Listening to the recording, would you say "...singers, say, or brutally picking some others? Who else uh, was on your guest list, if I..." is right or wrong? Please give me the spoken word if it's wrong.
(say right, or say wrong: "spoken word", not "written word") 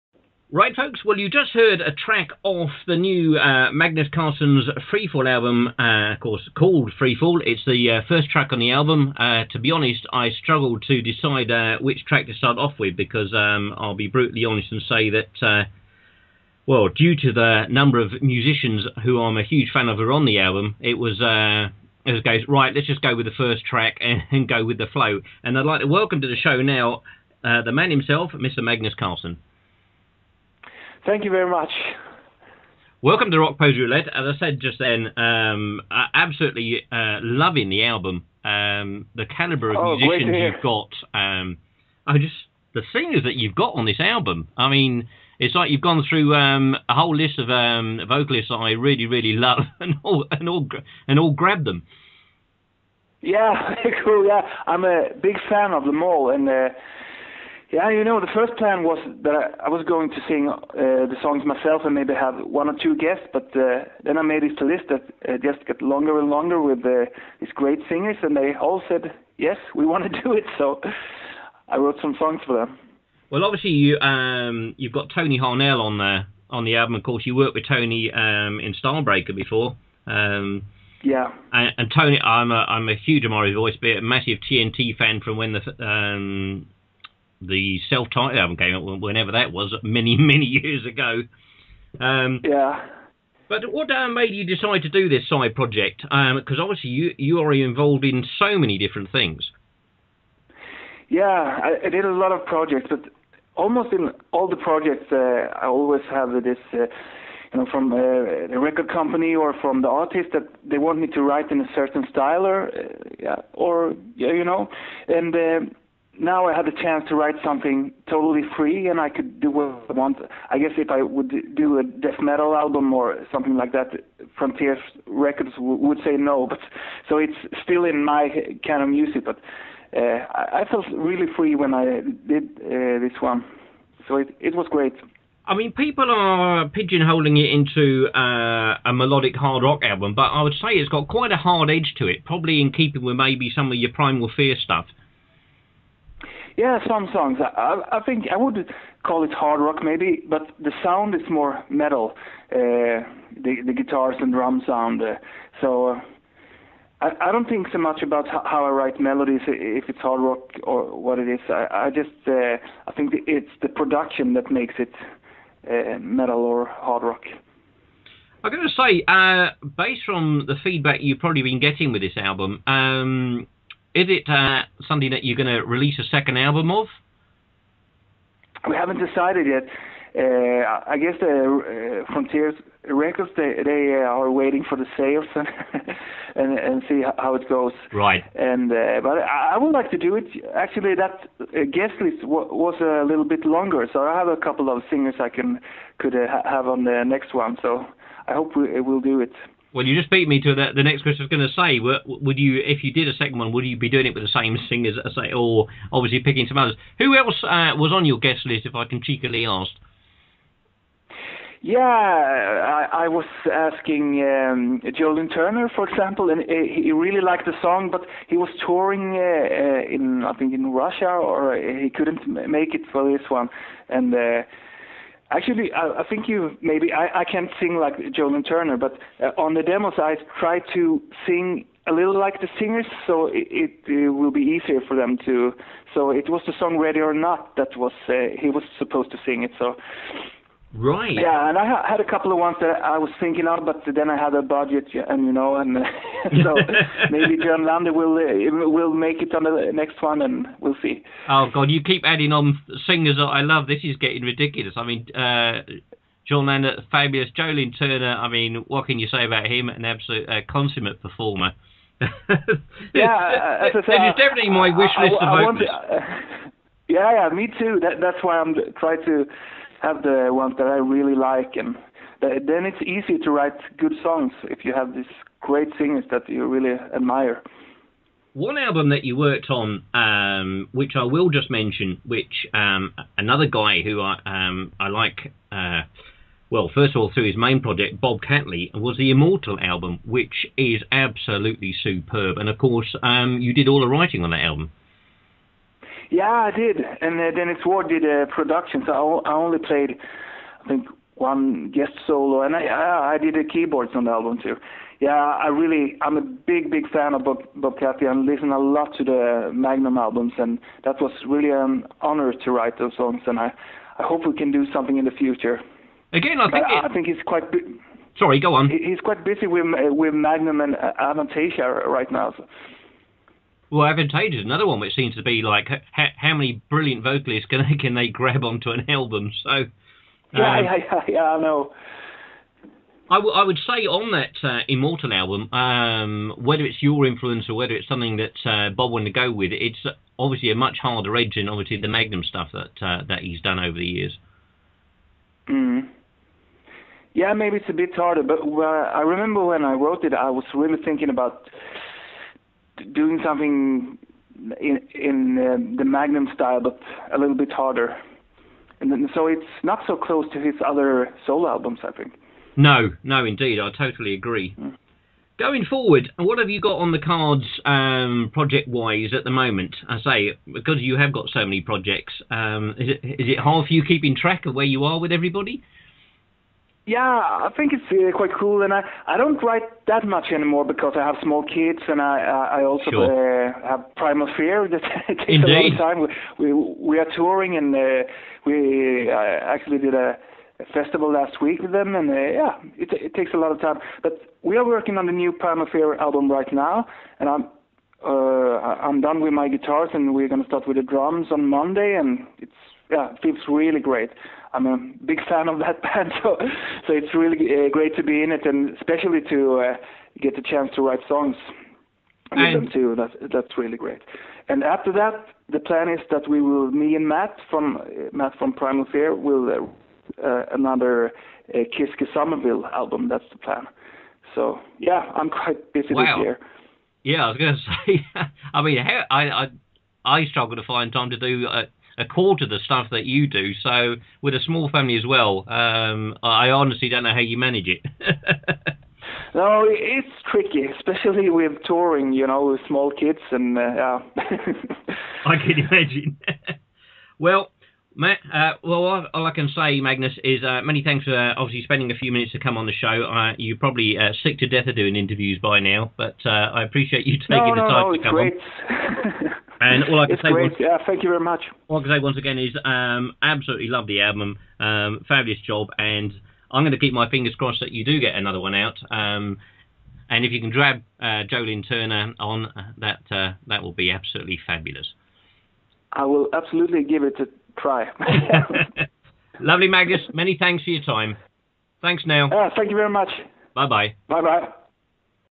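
wrong: "obviously", not "brutally".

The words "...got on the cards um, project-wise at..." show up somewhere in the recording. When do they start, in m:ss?
6:06.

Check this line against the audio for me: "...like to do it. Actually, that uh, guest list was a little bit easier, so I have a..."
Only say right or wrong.
wrong.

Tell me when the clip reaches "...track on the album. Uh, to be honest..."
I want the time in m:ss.
0:08.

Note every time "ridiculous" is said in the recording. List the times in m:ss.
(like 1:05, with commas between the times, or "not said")
4:14.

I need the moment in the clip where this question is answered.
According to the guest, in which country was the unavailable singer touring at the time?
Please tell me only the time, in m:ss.
3:40.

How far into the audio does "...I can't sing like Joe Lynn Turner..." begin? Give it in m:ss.
3:47.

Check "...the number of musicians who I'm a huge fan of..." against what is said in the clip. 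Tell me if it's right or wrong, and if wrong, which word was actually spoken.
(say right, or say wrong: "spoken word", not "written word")
right.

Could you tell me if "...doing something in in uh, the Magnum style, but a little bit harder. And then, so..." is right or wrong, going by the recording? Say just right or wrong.
right.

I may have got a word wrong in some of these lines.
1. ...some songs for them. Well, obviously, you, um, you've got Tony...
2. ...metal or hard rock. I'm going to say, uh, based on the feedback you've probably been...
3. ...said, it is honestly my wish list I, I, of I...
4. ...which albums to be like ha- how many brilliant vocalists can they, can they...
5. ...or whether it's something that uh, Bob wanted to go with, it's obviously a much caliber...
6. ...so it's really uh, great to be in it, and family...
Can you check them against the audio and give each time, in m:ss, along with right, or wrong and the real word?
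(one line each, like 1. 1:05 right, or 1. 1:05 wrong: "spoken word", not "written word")
1. 1:12 right
2. 2:45 right
3. 4:23 wrong: "definitely", not "honestly"
4. 5:24 wrong: "seems", not "albums"
5. 5:37 wrong: "harder", not "caliber"
6. 6:46 wrong: "especially", not "family".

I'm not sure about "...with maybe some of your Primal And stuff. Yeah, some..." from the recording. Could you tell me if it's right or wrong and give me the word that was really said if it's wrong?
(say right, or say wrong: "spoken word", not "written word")
wrong: "Fear", not "And".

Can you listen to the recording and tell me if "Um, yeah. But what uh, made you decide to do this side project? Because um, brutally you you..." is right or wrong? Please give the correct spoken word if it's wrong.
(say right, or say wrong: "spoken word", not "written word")
wrong: "obviously", not "brutally".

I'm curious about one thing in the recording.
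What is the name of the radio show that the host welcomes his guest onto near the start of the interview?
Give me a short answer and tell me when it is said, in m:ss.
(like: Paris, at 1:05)
Rockposer's Roulette, at 0:33.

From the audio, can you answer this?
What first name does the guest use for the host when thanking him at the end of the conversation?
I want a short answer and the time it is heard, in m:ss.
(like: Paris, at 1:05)
Neil, at 8:02.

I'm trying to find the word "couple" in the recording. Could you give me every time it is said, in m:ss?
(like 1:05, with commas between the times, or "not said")
3:14, 4:02.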